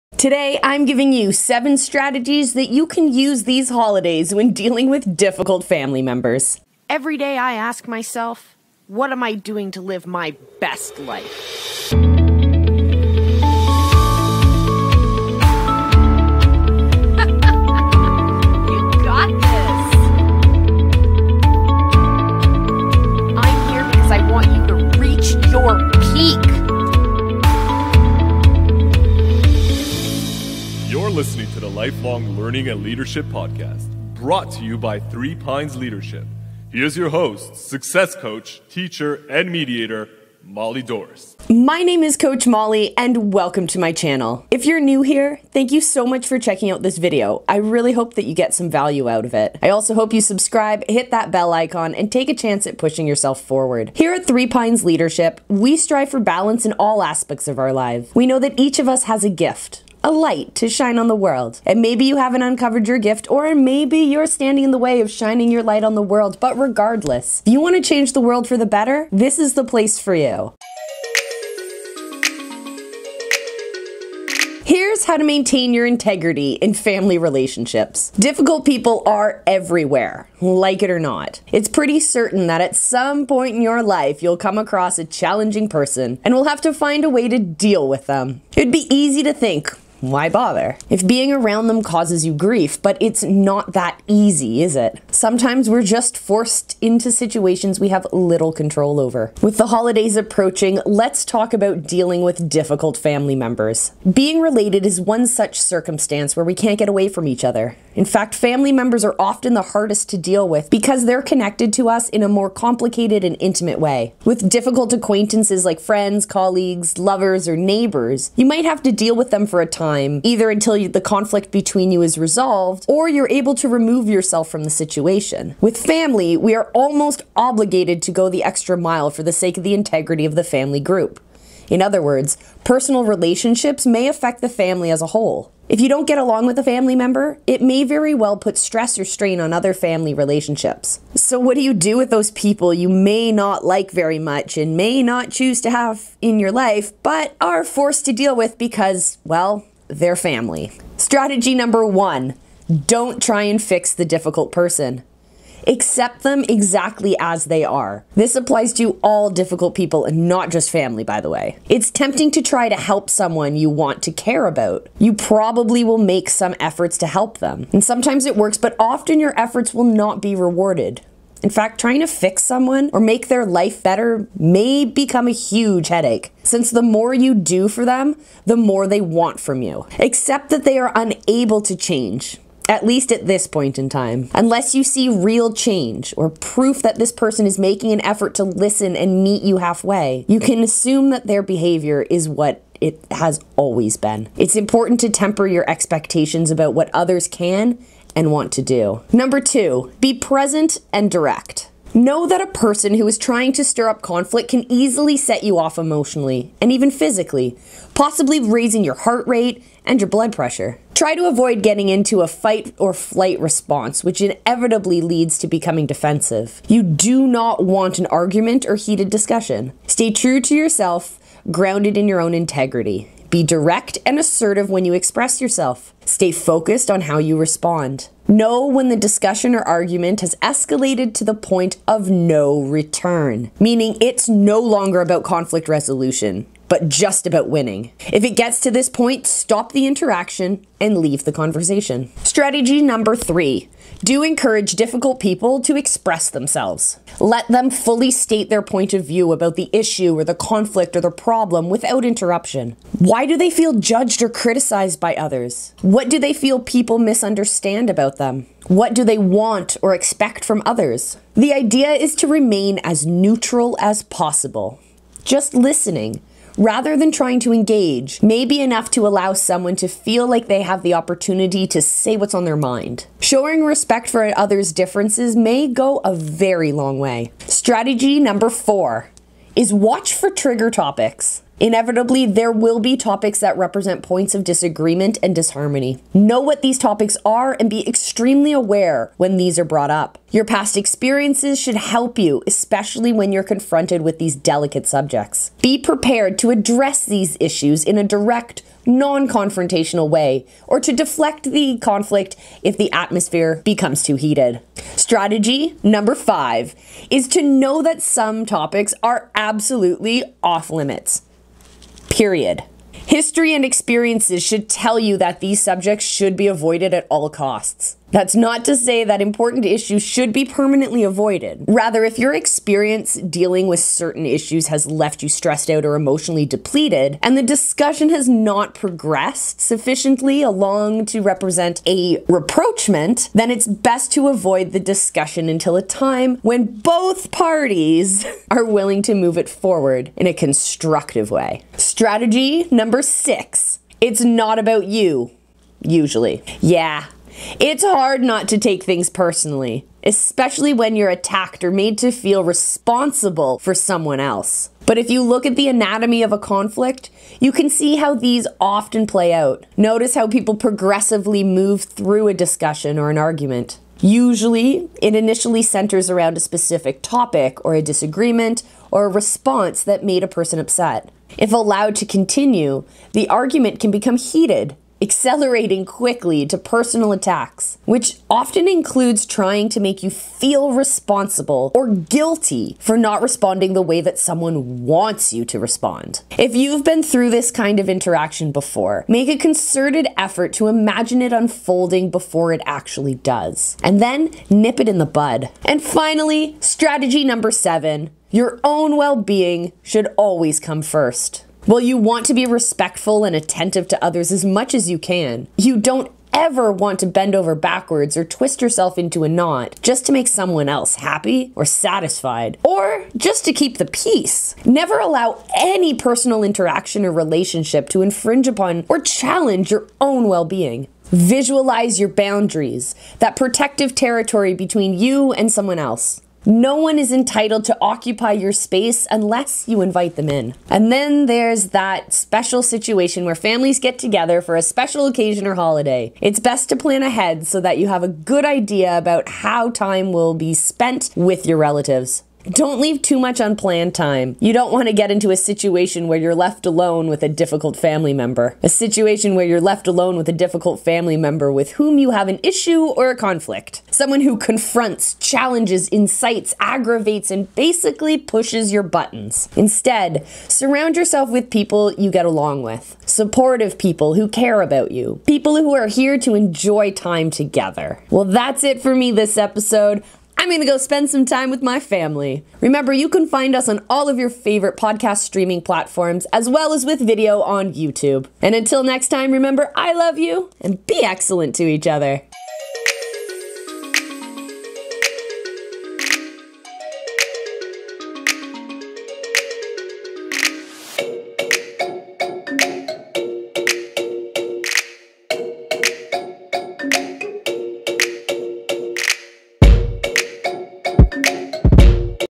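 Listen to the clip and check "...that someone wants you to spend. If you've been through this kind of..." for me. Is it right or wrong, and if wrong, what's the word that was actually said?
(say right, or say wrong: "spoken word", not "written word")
wrong: "respond", not "spend".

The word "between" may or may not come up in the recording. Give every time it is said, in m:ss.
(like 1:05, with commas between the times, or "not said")
2:01, 7:04.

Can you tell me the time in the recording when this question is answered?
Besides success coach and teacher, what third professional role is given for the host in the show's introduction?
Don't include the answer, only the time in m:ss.
0:39.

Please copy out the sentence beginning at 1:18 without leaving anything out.
Difficult people are everywhere, like it or not.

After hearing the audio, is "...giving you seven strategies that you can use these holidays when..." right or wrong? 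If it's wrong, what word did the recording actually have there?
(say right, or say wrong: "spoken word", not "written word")
right.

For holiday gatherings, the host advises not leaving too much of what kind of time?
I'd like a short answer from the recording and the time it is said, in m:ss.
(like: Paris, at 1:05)
Unplanned time, at 7:23.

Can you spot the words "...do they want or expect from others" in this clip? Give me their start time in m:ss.
4:18.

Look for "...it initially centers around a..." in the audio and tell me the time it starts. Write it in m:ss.
6:05.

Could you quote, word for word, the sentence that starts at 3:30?
Try to avoid getting into a fight or flight response, which inevitably leads to becoming defensive.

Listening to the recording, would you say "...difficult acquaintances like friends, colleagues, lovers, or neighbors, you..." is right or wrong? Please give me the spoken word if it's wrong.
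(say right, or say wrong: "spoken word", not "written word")
right.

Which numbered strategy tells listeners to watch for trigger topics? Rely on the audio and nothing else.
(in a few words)
4.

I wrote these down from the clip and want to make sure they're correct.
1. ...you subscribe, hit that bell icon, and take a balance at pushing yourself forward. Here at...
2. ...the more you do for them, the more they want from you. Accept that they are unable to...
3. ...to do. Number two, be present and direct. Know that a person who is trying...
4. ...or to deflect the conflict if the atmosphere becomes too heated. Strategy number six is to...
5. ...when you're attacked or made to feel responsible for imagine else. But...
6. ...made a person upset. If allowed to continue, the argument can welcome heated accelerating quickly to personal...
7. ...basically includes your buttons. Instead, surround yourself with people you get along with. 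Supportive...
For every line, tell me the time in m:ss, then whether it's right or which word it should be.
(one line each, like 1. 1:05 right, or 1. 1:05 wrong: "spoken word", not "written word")
1. 0:50 wrong: "chance", not "balance"
2. 2:56 right
3. 3:18 right
4. 5:00 wrong: "five", not "six"
5. 5:50 wrong: "someone", not "imagine"
6. 6:10 wrong: "become", not "welcome"
7. 7:37 wrong: "pushes", not "includes".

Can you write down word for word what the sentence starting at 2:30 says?
Strategy number one don't try and fix the difficult person.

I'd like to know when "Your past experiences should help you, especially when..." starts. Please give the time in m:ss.
4:50.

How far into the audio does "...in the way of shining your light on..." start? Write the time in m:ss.
1:04.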